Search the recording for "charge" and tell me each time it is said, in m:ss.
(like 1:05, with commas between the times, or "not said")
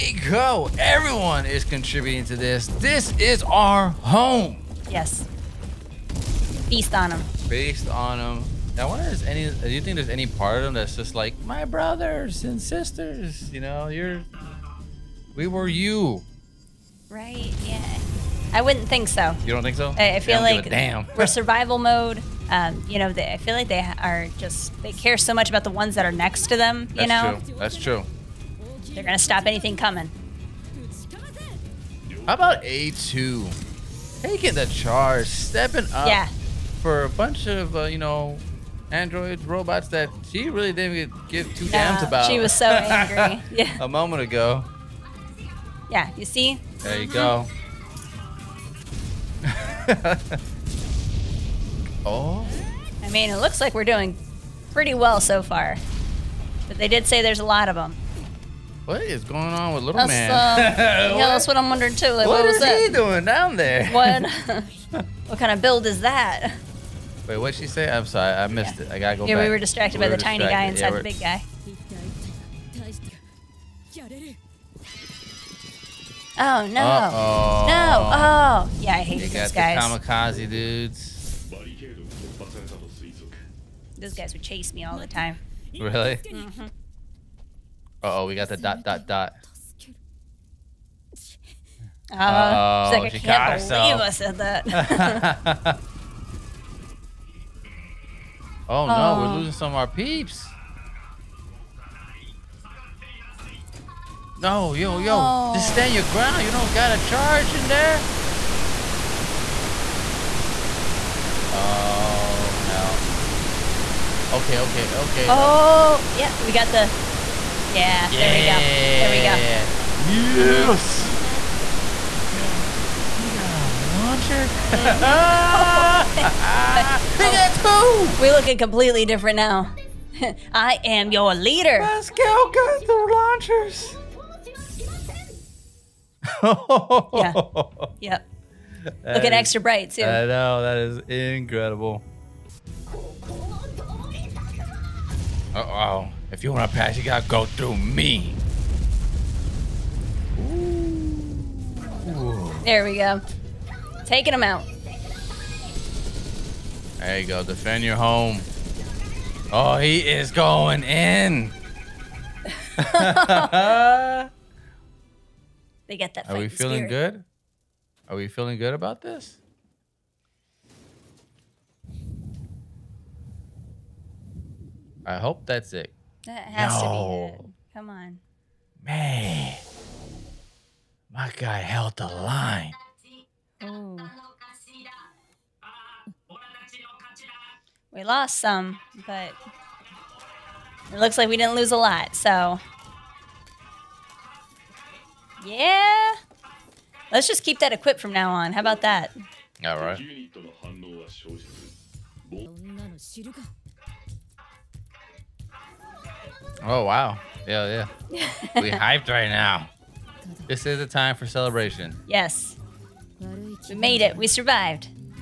0:34, 1:46.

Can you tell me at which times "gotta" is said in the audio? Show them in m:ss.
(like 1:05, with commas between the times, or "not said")
1:08, 2:27.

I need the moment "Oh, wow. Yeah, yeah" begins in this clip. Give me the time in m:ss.
3:26.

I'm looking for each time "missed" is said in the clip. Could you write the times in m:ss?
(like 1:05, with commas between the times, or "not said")
1:08.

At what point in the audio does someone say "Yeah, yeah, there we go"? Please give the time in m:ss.
1:57.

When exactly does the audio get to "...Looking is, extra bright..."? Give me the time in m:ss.
2:19.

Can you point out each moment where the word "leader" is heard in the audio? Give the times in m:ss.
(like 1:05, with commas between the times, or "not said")
2:11.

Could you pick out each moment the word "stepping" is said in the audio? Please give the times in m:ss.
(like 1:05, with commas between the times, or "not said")
0:35.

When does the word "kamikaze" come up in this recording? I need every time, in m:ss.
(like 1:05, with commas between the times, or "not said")
1:19.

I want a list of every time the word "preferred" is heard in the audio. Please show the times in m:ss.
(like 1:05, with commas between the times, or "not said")
not said.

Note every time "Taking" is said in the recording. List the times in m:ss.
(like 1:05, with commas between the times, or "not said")
0:34, 2:34.